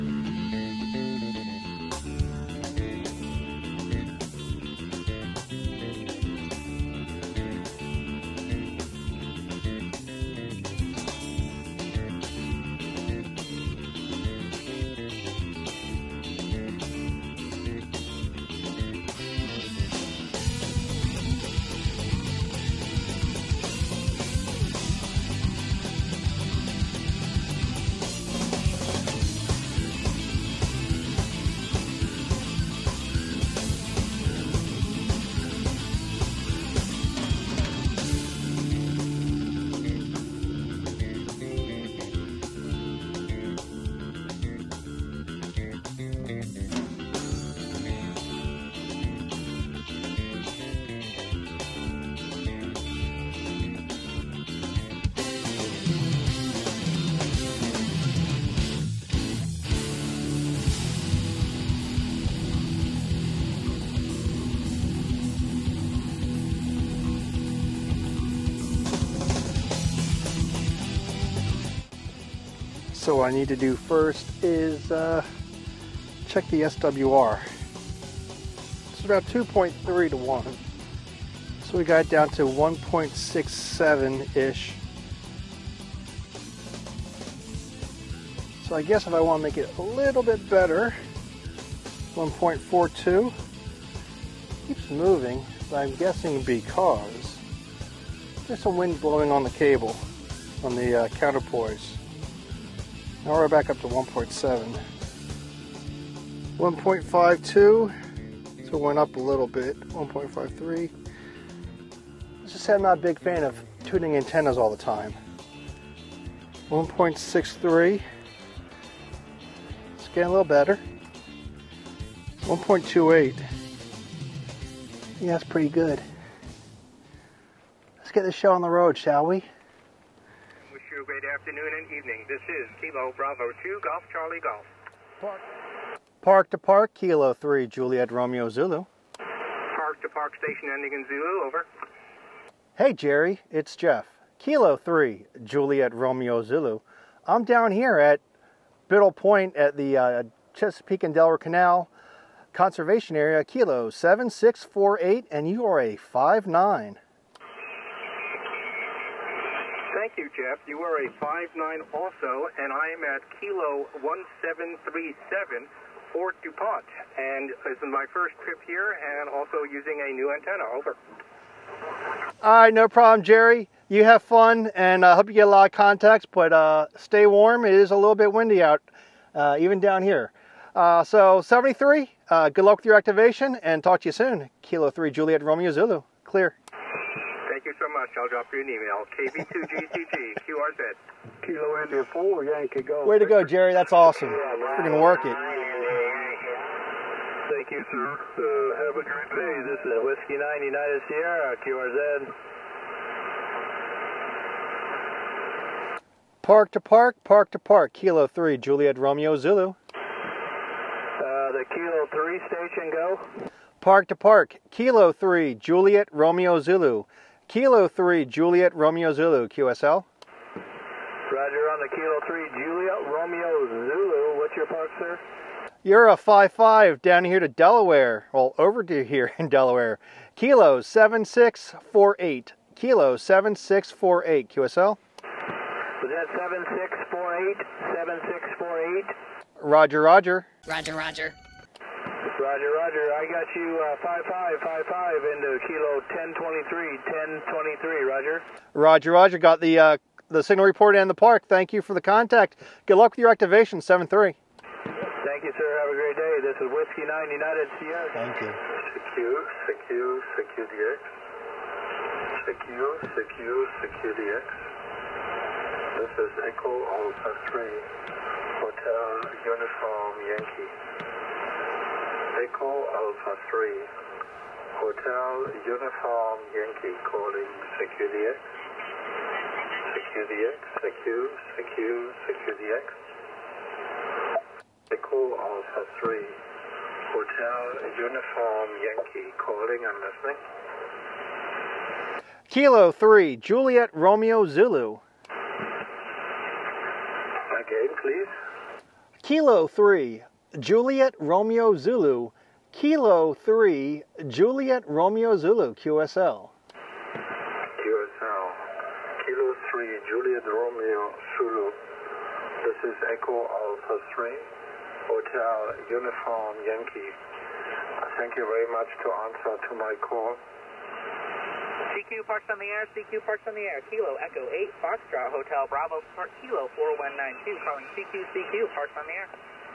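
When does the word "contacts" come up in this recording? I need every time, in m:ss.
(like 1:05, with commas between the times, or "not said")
2:55, 4:12.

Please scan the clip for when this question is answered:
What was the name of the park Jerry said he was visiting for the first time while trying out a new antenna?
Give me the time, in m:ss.
2:46.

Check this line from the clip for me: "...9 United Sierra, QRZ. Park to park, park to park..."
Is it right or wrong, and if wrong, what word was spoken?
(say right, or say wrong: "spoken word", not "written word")
right.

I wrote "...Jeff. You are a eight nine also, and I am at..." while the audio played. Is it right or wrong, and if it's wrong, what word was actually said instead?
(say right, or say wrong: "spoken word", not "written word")
wrong: "five", not "eight".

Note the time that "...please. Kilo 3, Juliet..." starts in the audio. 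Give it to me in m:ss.
4:58.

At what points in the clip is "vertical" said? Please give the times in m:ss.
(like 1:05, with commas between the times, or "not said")
not said.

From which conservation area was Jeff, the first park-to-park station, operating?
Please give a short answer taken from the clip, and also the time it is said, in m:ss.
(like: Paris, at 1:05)
Chesapeake and Delaware Canal, at 2:30.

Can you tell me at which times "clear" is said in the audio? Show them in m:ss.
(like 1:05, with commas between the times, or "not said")
3:06.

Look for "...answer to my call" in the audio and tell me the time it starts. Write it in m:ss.
5:19.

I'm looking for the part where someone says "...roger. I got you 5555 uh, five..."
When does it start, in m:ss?
4:02.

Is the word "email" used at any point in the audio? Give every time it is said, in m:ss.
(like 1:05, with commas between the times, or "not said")
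3:08.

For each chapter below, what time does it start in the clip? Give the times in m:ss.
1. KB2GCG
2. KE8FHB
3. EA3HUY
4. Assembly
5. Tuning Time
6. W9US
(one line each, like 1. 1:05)
1. 2:10
2. 5:20
3. 4:17
4. 0:12
5. 1:10
6. 3:15.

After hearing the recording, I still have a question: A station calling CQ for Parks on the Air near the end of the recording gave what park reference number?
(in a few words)
4192.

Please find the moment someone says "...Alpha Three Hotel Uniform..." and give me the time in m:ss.
4:26.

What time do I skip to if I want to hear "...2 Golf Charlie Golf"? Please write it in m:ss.
2:13.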